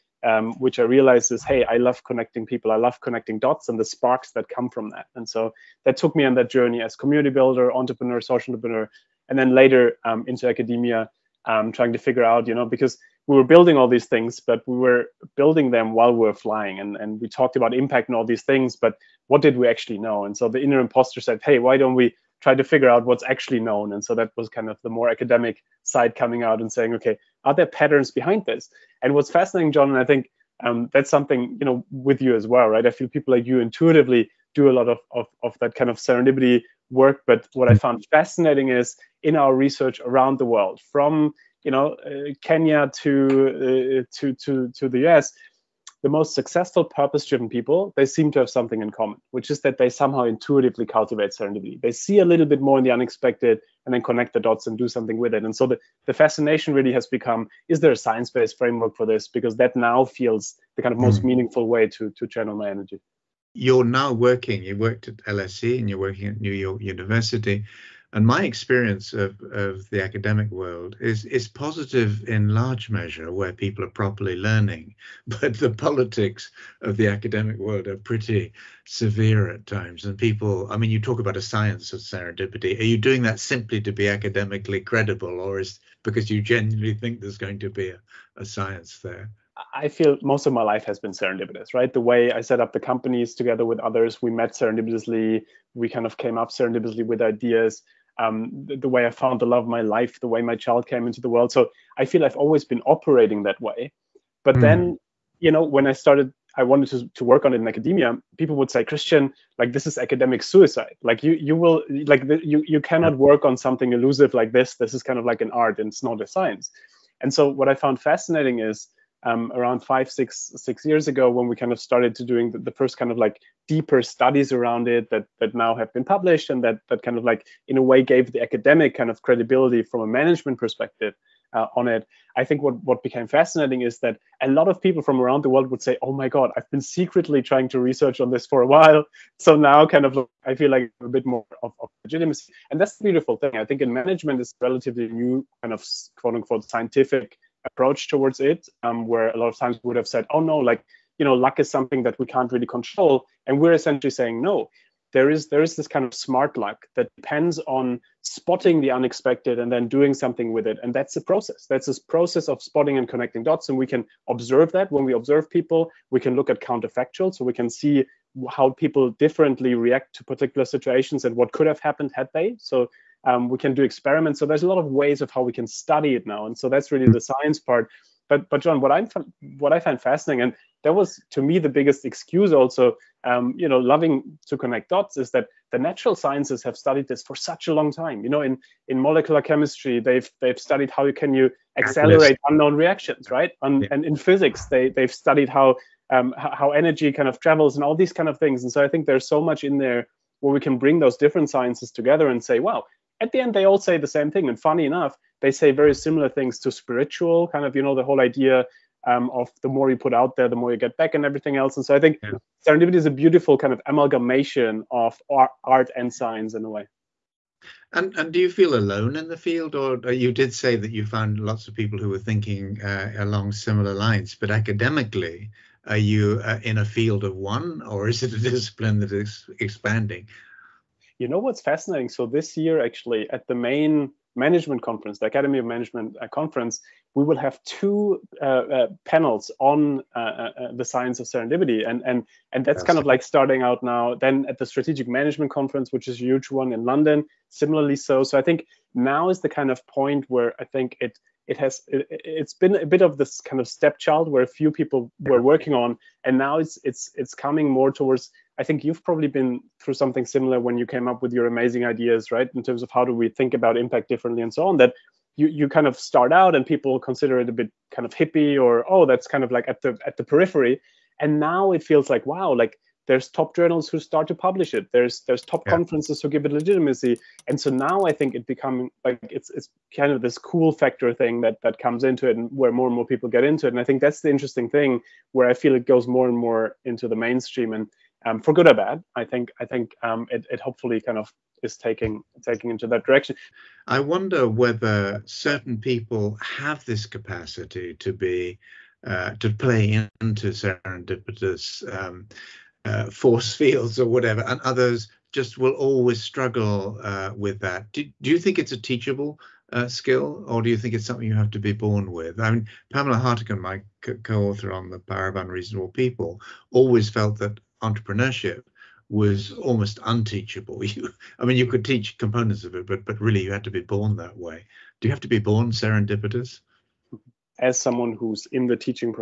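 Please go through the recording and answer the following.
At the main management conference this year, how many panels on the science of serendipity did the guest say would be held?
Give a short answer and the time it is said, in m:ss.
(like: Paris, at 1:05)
2, at 3:57.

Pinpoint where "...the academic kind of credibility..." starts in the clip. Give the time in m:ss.
2:08.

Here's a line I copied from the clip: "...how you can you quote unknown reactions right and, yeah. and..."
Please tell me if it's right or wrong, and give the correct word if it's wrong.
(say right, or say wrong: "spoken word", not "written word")
wrong: "accelerate", not "quote".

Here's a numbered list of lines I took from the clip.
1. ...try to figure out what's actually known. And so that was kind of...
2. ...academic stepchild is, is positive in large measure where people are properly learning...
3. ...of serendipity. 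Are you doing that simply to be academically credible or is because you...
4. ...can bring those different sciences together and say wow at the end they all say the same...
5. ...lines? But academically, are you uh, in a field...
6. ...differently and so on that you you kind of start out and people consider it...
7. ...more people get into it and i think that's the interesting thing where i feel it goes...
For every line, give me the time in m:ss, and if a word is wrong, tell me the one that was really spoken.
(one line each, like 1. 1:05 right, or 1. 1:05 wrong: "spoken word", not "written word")
1. 0:22 right
2. 1:10 wrong: "world", not "stepchild"
3. 1:21 right
4. 3:20 right
5. 3:43 right
6. 4:24 right
7. 4:42 right.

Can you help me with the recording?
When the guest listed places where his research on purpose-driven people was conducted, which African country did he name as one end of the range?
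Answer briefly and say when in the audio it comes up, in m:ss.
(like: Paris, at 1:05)
Kenya, at 0:42.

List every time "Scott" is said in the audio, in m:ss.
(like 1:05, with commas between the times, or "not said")
not said.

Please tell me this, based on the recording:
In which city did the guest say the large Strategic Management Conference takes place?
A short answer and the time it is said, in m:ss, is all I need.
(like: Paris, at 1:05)
London, at 4:06.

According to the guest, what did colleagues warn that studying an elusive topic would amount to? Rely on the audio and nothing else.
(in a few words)
academic suicide.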